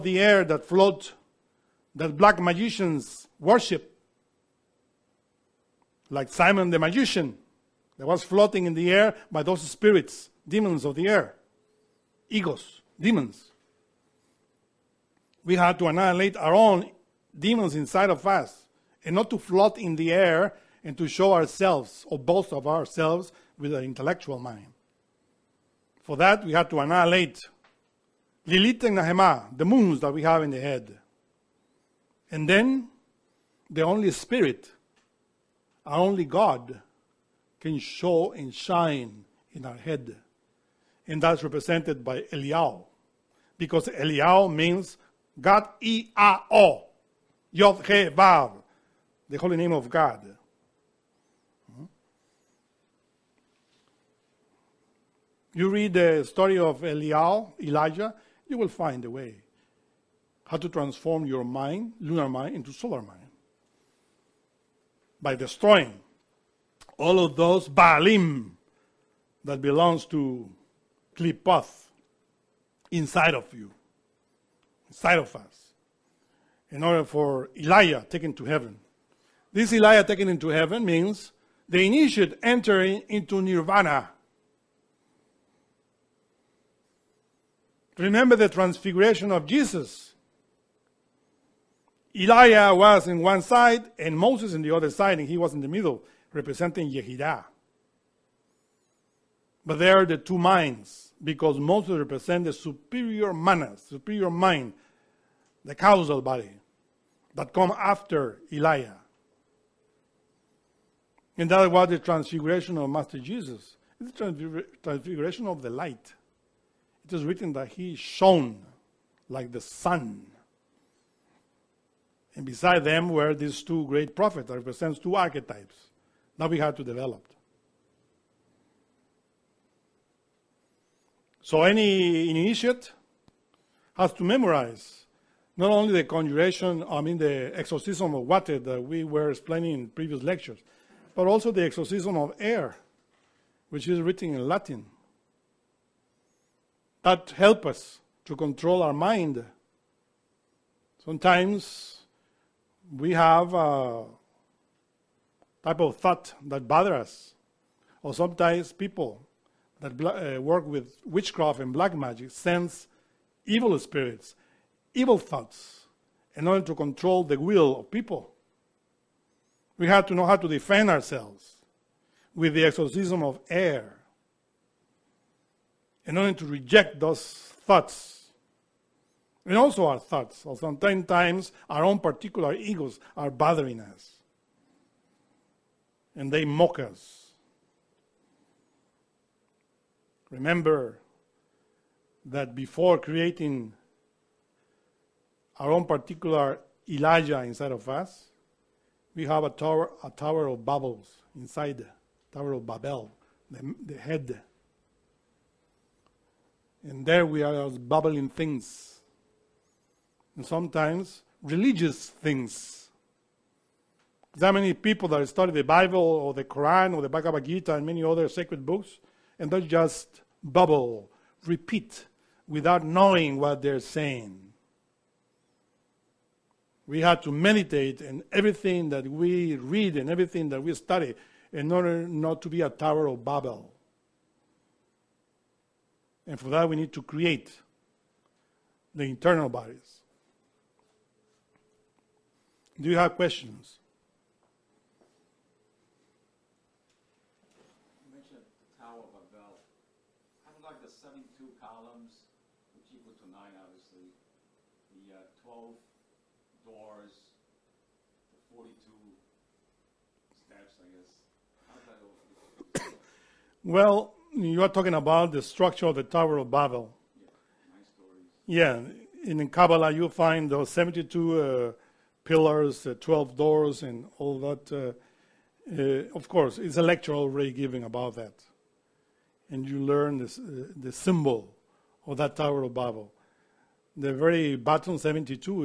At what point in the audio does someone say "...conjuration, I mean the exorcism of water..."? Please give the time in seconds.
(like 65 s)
136 s.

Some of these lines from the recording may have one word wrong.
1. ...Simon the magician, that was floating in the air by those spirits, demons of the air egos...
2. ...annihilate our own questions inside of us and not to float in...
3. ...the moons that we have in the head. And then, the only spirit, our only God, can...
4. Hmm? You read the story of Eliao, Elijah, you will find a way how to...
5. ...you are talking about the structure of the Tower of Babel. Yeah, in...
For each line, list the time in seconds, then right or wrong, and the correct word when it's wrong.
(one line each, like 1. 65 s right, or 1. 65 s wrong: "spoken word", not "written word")
1. 6 s right
2. 15 s wrong: "demons", not "questions"
3. 29 s right
4. 51 s right
5. 264 s right.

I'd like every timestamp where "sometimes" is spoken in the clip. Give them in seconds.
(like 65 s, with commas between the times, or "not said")
151 s, 158 s, 180 s, 210 s.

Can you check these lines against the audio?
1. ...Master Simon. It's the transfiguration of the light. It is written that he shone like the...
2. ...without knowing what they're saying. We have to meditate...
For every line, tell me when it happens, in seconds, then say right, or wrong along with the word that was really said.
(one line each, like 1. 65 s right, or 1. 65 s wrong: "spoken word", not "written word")
1. 112 s wrong: "Jesus", not "Simon"
2. 222 s right.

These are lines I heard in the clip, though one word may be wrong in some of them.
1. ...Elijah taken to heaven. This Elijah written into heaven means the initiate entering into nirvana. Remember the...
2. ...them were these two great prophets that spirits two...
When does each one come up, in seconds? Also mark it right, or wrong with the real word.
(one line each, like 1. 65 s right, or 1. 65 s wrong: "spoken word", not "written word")
1. 77 s wrong: "taken", not "written"
2. 122 s wrong: "represents", not "spirits".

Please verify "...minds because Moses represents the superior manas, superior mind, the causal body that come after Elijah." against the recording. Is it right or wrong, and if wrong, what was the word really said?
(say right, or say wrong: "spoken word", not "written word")
right.